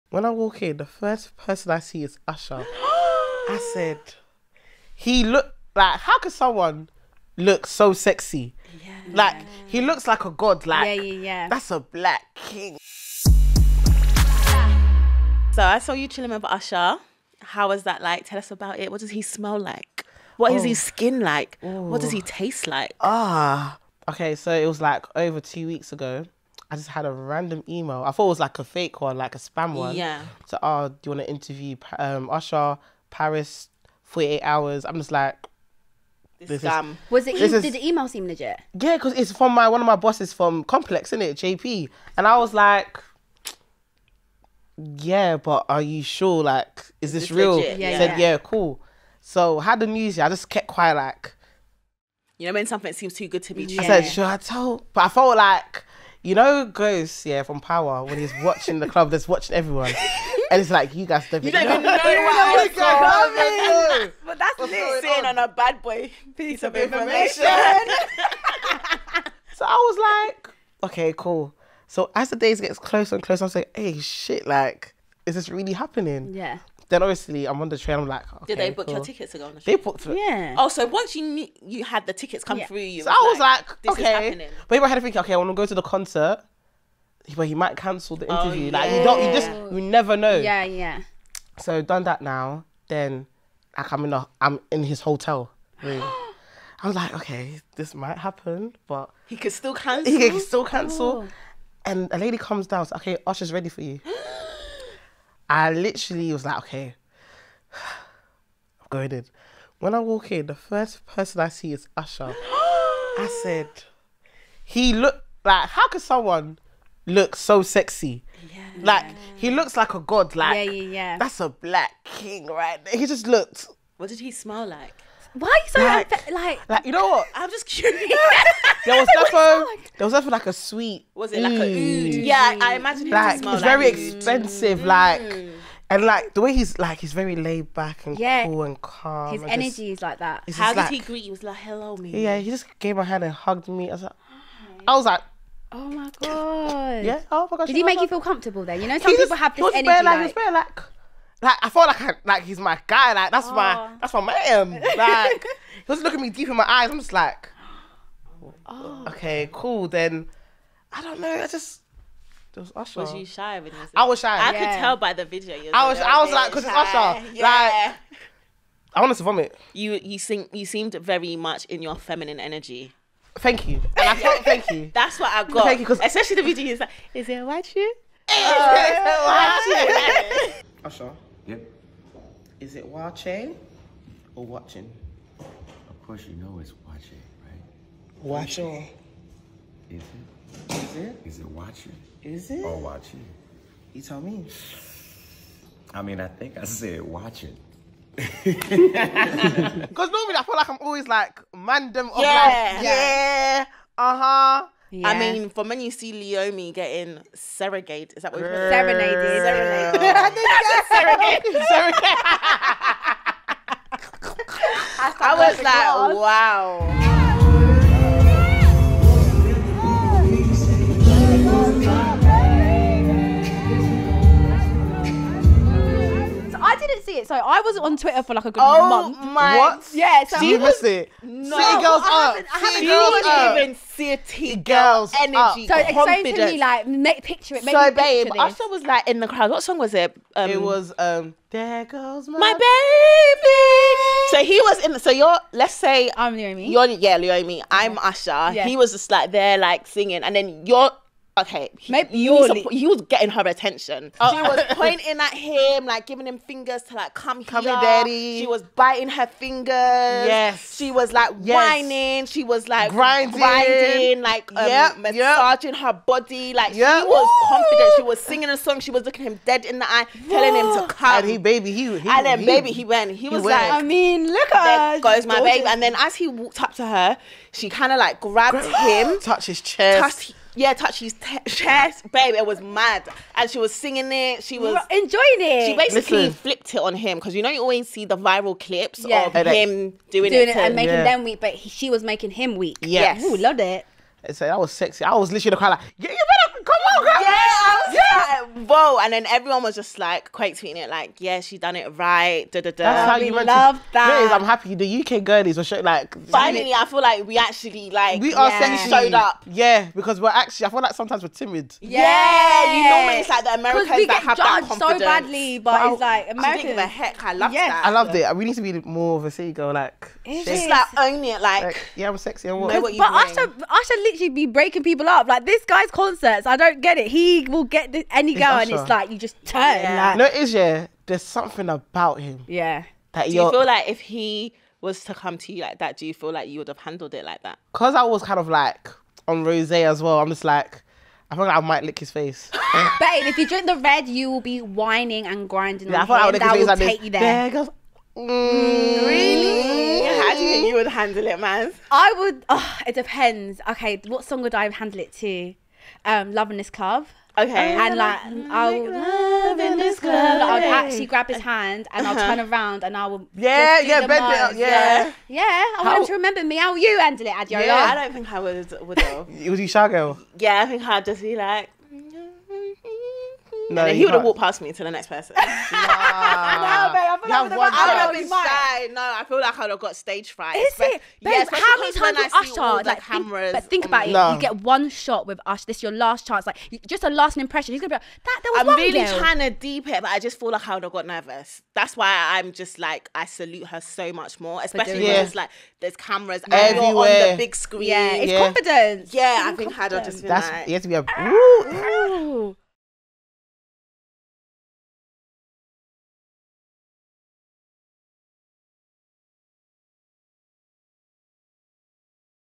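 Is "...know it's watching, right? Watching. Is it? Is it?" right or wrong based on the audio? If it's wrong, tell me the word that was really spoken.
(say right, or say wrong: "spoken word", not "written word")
right.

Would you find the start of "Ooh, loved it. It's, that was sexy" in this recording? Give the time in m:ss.
4:53.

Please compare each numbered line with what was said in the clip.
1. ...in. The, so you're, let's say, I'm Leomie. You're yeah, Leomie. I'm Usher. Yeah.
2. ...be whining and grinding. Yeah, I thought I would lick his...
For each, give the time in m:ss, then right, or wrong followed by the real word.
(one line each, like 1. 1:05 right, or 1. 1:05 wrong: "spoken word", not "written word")
1. 4:04 right
2. 5:44 right.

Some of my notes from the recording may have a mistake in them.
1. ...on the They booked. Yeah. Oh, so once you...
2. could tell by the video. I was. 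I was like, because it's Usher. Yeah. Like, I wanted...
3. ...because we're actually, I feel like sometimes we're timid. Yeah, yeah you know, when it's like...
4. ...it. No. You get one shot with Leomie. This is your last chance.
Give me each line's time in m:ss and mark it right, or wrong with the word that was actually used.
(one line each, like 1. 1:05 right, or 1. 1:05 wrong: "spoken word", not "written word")
1. 1:19 right
2. 2:44 right
3. 5:09 right
4. 6:24 wrong: "Usher", not "Leomie".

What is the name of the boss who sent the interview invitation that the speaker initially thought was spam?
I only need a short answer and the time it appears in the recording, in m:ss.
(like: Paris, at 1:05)
JP, at 0:41.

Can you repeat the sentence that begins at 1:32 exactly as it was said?
Then, like I'm in the, i I'm in his hotel room.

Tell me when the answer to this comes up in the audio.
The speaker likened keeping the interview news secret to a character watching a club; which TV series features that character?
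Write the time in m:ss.
0:57.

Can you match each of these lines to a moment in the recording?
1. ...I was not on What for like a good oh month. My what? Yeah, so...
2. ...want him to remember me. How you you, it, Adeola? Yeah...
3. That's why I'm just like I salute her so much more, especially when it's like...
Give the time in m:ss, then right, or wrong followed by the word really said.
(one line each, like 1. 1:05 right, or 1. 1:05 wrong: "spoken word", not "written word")
1. 3:47 wrong: "Twitter", not "What"
2. 6:05 right
3. 6:31 right.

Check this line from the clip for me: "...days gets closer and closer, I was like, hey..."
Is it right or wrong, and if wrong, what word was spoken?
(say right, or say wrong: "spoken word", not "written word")
right.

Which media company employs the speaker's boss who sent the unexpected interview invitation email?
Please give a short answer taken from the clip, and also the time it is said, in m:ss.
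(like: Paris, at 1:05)
Complex, at 0:40.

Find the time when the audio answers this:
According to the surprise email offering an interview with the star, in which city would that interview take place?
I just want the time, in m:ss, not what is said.
0:33.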